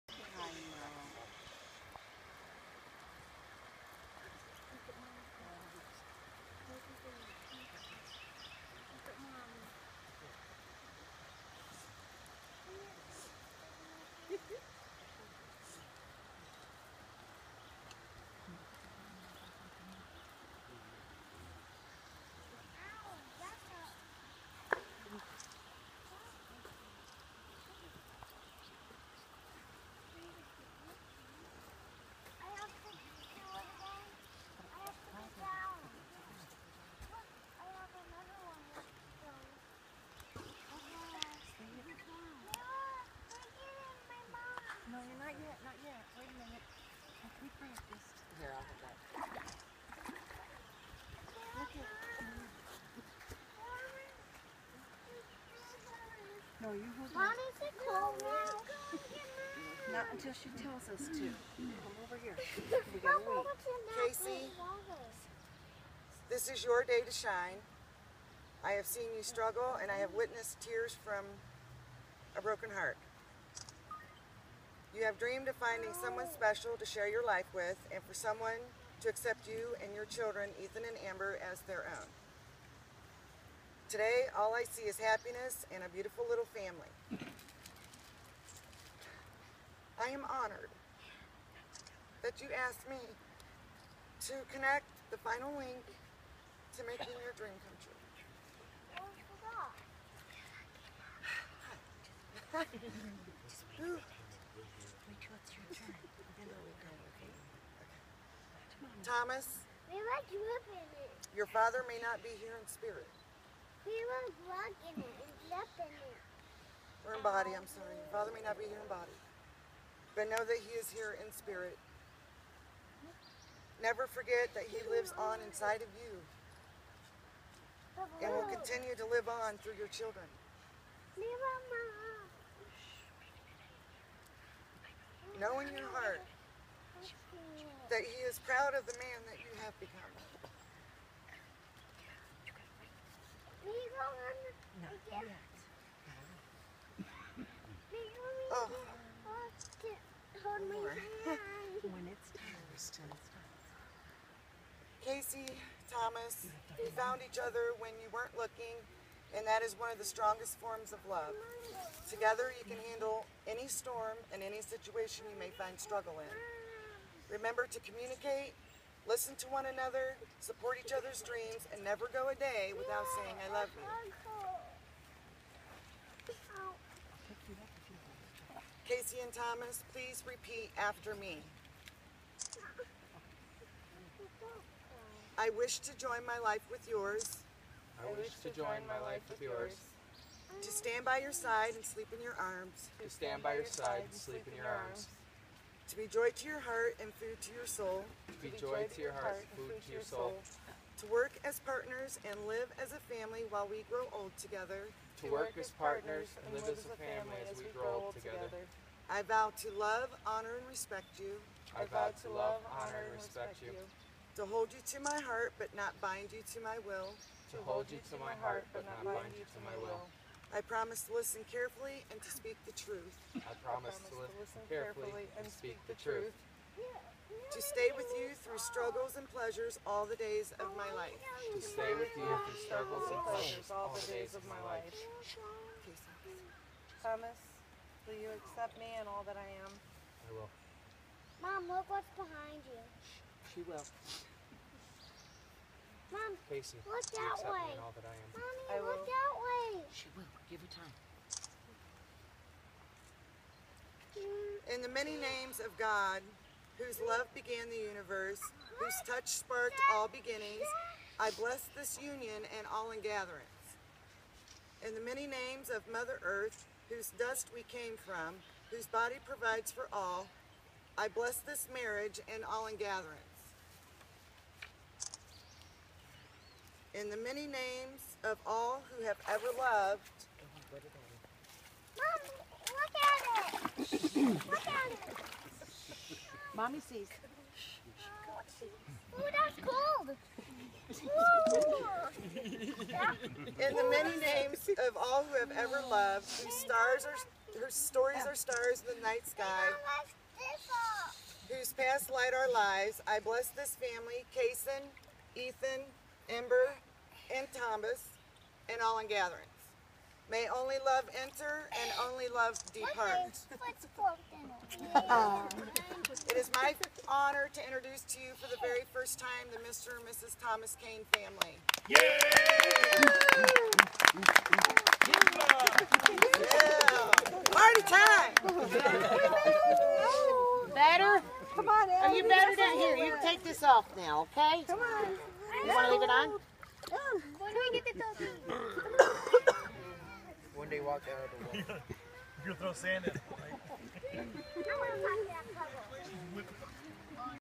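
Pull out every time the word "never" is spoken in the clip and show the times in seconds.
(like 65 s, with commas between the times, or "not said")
123 s, 171 s.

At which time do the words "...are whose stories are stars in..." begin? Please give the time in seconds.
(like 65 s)
297 s.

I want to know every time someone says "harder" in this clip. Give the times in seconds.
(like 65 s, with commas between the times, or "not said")
not said.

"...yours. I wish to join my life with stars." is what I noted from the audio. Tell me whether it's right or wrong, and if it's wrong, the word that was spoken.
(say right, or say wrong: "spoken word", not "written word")
wrong: "yours", not "stars".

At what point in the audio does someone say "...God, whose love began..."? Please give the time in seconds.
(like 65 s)
255 s.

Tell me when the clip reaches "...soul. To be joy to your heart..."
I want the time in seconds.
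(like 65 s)
197 s.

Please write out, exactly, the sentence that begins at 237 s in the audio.
Thomas, will you accept me and all that I am?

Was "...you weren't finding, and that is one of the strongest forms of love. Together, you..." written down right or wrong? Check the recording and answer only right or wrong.
wrong.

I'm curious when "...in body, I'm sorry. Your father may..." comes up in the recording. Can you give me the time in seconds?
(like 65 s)
117 s.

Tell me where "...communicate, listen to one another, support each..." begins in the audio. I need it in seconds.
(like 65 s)
167 s.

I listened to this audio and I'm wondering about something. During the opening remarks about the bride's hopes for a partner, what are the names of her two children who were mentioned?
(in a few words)
Ethan and Amber.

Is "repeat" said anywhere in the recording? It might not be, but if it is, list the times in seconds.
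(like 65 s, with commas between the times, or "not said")
180 s.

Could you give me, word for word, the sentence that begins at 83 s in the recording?
Today, all I see is happiness and a beautiful little family.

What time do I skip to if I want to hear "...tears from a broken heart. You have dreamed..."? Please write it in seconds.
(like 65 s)
70 s.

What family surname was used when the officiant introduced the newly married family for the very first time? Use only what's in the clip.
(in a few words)
Kane.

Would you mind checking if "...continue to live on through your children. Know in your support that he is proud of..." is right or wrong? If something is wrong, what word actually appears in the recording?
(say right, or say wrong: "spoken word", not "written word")
wrong: "heart", not "support".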